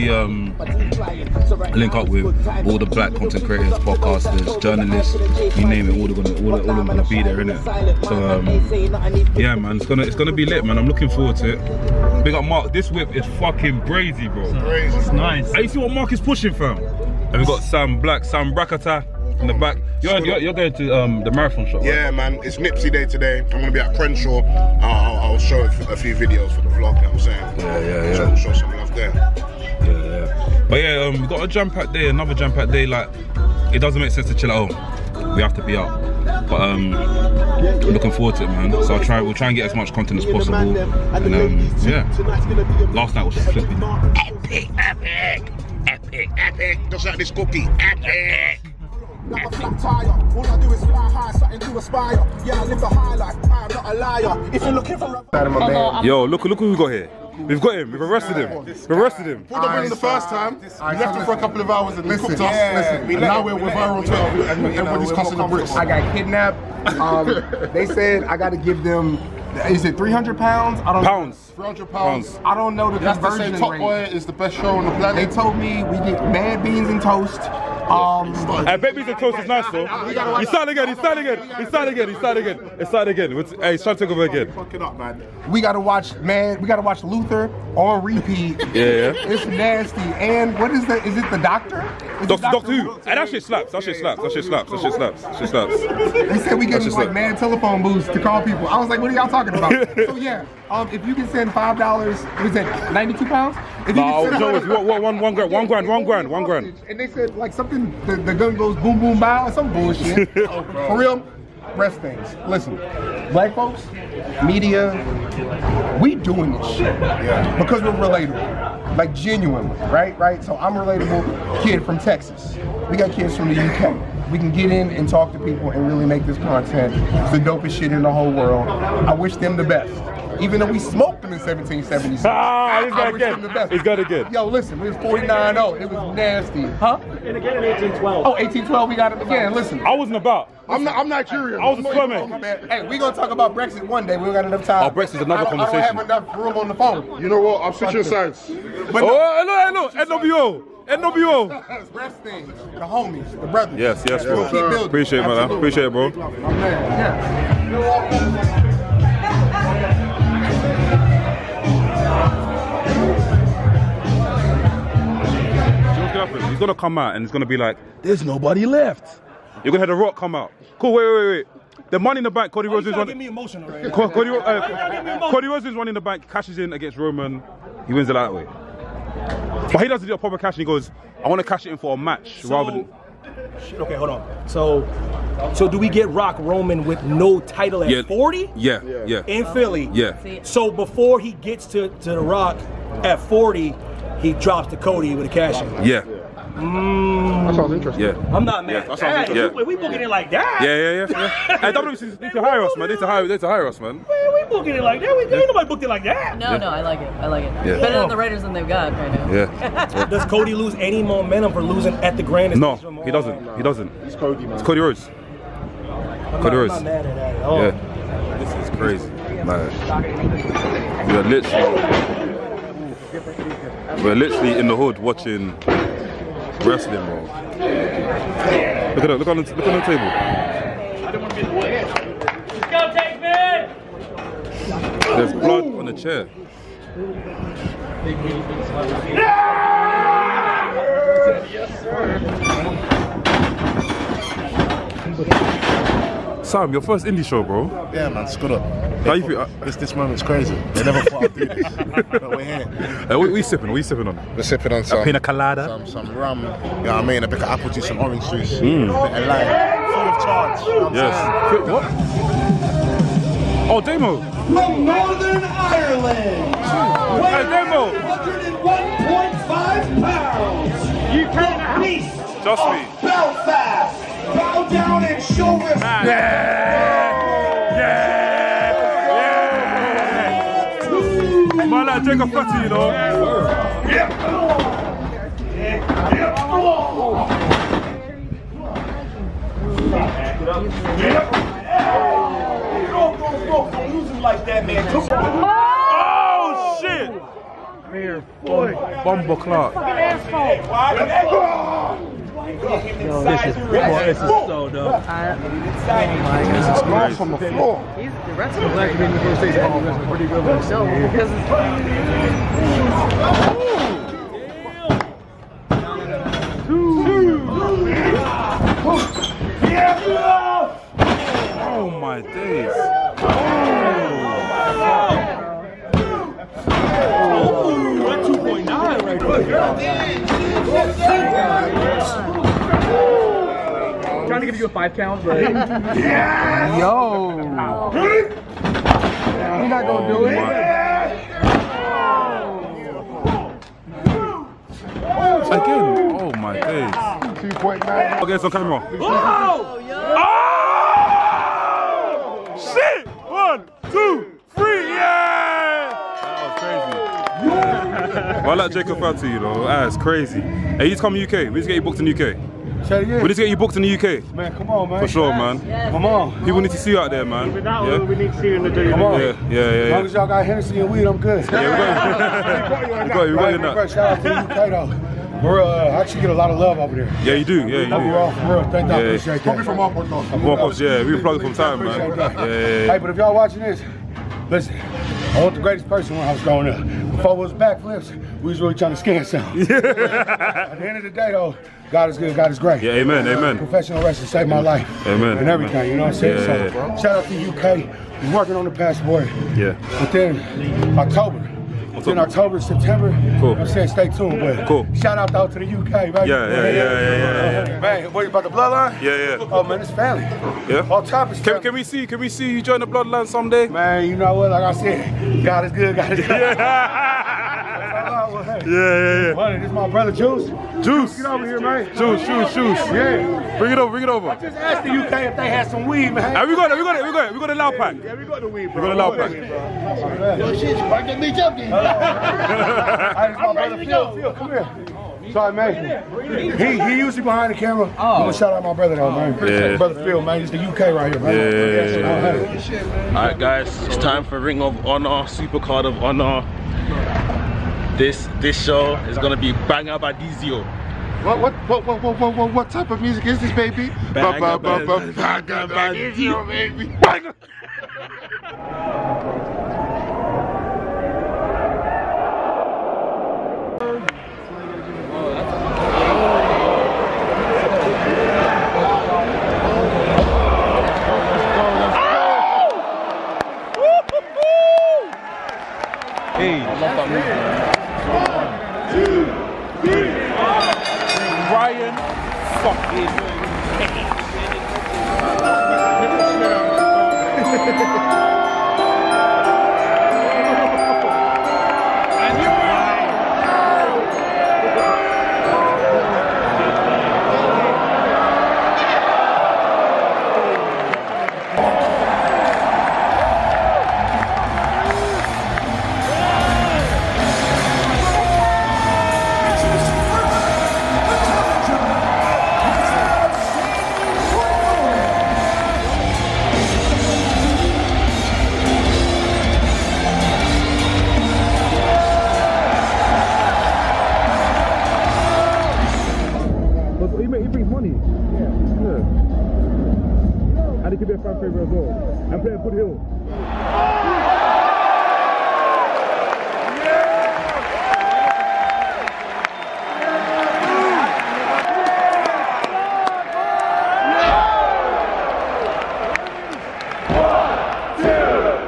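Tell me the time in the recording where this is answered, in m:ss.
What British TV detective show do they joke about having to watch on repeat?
1:27.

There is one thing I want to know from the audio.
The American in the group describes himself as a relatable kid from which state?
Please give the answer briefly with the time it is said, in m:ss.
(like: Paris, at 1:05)
Texas, at 2:01.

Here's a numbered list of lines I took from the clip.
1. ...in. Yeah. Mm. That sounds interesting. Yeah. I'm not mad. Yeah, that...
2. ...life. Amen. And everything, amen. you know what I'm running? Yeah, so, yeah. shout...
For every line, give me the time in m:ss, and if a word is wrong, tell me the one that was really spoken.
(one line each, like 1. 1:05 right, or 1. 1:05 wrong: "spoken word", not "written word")
1. 3:15 right
2. 6:34 wrong: "saying", not "running".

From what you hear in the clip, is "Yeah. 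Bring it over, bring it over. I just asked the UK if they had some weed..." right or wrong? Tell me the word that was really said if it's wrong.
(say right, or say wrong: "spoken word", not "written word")
right.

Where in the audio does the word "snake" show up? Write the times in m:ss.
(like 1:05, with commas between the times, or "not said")
not said.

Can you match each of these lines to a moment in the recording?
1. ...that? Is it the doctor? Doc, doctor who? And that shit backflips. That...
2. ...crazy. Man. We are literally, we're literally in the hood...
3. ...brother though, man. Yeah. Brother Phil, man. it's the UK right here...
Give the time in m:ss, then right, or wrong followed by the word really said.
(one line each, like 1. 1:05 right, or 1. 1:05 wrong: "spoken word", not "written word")
1. 1:30 wrong: "slaps", not "backflips"
2. 3:38 right
3. 7:18 right.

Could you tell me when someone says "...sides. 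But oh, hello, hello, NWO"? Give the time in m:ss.
2:28.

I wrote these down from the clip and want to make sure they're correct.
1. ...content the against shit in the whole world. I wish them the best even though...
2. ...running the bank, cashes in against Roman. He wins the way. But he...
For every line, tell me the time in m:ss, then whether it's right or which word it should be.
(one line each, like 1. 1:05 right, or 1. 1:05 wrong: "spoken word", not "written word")
1. 2:06 wrong: "dopest", not "against"
2. 2:55 right.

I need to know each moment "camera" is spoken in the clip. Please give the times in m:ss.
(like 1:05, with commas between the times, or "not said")
5:48, 7:17.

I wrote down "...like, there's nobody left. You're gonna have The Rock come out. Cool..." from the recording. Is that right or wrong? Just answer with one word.
right.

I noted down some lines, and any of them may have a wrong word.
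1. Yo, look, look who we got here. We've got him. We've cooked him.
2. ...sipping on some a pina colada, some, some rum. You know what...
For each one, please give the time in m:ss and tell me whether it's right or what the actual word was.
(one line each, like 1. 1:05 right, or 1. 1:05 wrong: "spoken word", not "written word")
1. 0:56 wrong: "arrested", not "cooked"
2. 4:14 right.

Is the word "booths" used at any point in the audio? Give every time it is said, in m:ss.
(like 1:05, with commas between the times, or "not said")
1:37.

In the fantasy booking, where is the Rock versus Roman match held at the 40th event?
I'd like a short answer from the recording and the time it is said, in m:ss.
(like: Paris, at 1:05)
Philly, at 3:09.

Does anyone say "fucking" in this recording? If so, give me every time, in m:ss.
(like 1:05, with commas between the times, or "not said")
0:13, 1:24, 4:59.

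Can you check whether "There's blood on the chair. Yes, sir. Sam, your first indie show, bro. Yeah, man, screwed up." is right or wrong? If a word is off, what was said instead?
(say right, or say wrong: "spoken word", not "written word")
right.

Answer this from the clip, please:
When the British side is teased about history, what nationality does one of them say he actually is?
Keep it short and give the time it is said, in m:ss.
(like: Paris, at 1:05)
Nigerian, at 2:21.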